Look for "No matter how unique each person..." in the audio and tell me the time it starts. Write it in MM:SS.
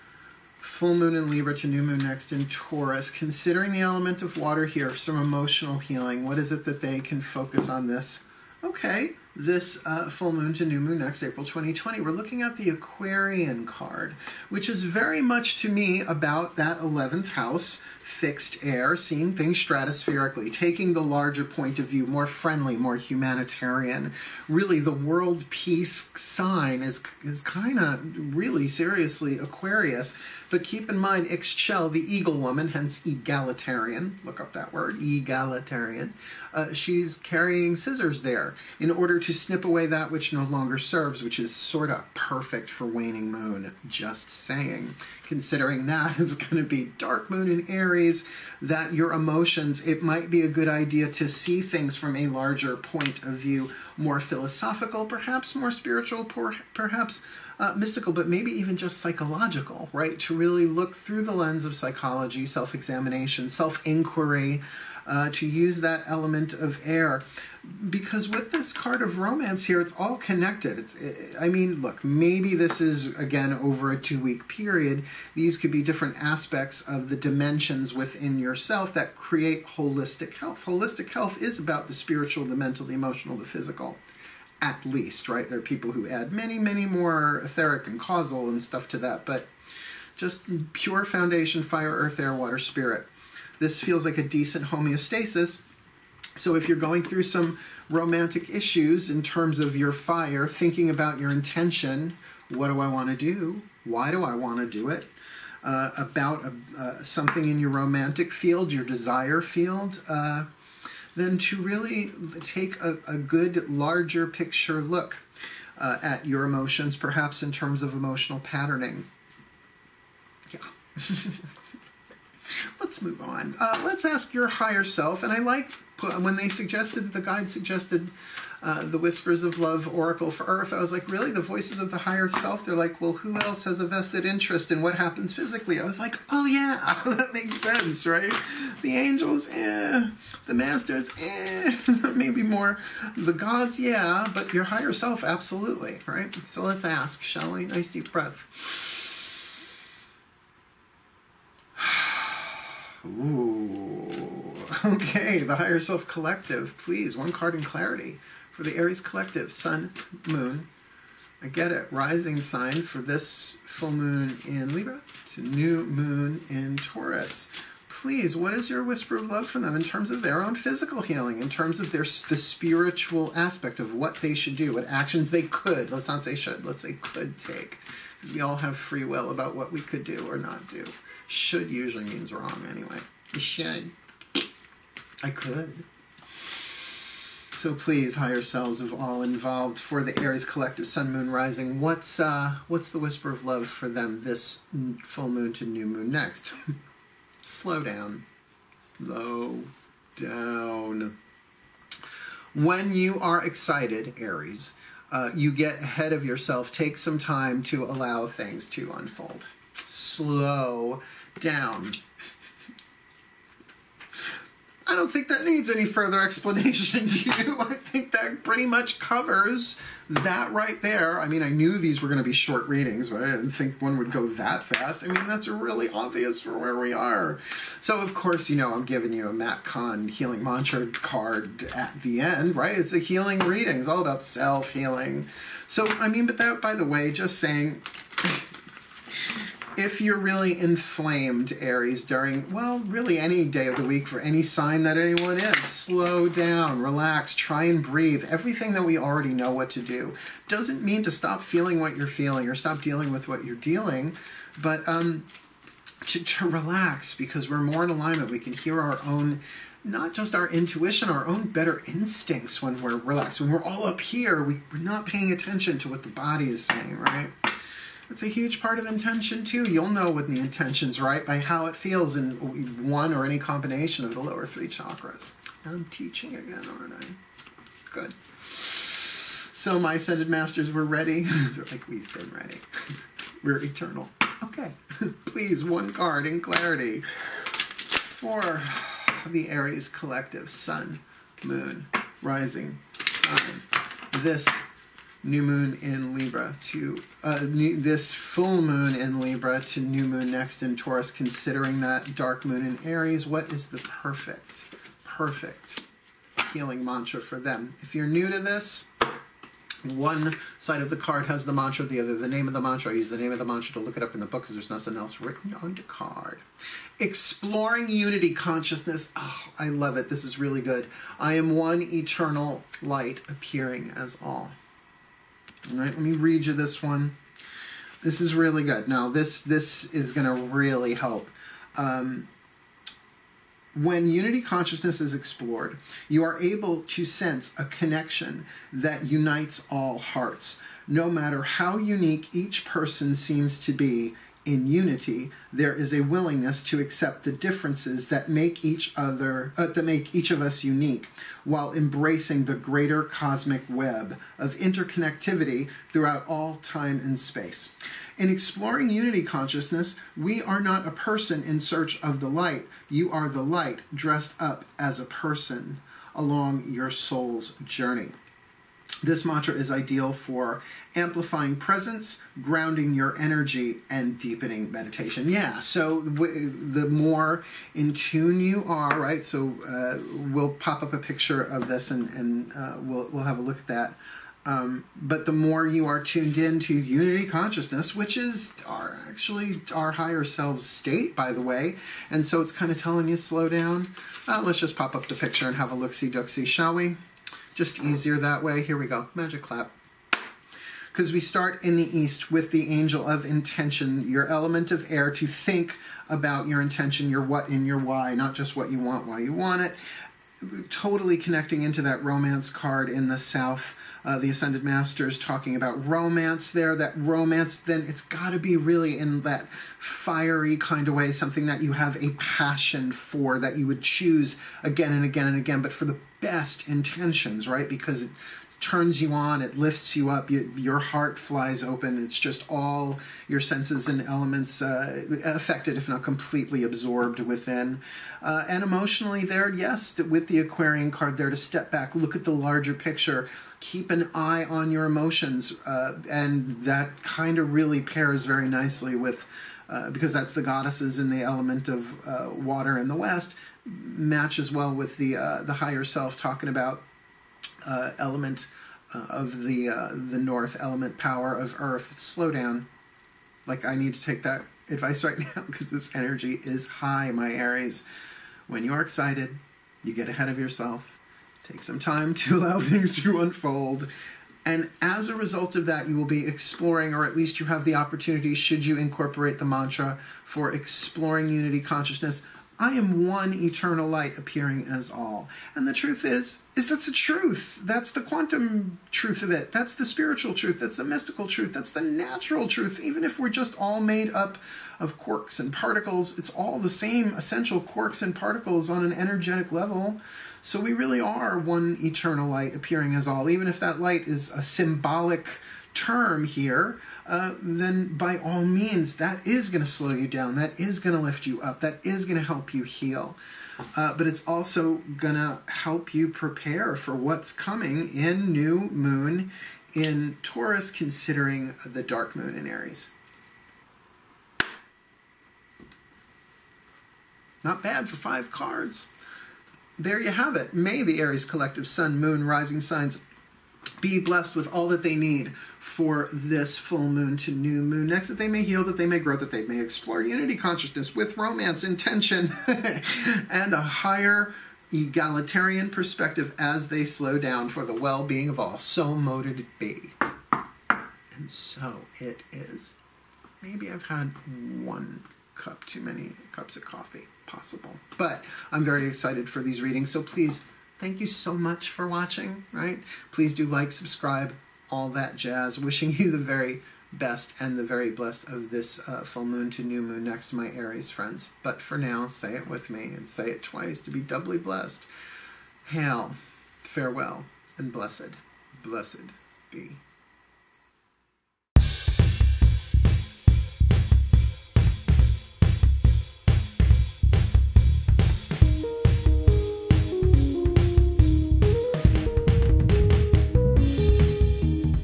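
05:40.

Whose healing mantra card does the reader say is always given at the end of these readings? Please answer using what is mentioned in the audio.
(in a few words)
Matt Kahn.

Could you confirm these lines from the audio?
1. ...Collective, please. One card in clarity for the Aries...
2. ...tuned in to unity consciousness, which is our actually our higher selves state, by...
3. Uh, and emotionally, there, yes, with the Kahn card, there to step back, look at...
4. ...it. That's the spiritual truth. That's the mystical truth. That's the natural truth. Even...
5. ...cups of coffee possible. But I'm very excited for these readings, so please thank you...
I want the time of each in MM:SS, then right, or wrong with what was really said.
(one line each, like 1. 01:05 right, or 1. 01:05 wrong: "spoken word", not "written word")
1. 02:36 right
2. 06:26 right
3. 07:18 wrong: "Aquarian", not "Kahn"
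4. 08:09 right
5. 09:16 right.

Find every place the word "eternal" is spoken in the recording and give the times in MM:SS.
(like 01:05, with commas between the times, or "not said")
04:43, 05:21, 08:03, 08:21.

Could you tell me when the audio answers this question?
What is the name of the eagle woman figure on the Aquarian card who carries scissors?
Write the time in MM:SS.
00:31.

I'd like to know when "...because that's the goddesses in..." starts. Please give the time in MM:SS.
07:29.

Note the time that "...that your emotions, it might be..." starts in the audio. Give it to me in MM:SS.
00:48.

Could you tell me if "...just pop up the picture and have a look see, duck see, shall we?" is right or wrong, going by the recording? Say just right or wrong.
right.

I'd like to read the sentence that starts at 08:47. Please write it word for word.
Not bad for five cards there you have it.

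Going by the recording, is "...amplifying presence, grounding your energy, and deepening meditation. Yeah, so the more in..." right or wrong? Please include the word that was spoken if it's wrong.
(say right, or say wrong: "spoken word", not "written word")
right.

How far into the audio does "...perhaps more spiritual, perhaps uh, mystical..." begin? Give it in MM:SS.
00:55.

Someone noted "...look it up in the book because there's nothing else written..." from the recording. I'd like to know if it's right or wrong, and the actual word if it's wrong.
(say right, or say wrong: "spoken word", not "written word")
right.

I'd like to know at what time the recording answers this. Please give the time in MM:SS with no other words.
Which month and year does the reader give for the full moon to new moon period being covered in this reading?
00:11.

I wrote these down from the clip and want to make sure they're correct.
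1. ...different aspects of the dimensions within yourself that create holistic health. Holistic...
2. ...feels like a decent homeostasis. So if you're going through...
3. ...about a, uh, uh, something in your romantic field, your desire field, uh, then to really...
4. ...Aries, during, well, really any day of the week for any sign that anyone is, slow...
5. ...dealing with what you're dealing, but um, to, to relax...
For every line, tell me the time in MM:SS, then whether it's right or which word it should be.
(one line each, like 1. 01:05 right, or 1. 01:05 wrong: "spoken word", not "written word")
1. 01:15 right
2. 01:33 right
3. 01:45 right
4. 04:01 right
5. 04:12 right.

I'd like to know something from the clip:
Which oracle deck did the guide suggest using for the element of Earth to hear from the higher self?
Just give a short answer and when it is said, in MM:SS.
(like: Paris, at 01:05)
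Whispers of Love Oracle, at 02:08.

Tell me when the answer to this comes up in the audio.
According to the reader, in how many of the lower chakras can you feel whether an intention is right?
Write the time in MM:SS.
04:34.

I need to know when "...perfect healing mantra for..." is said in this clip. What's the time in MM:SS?
05:05.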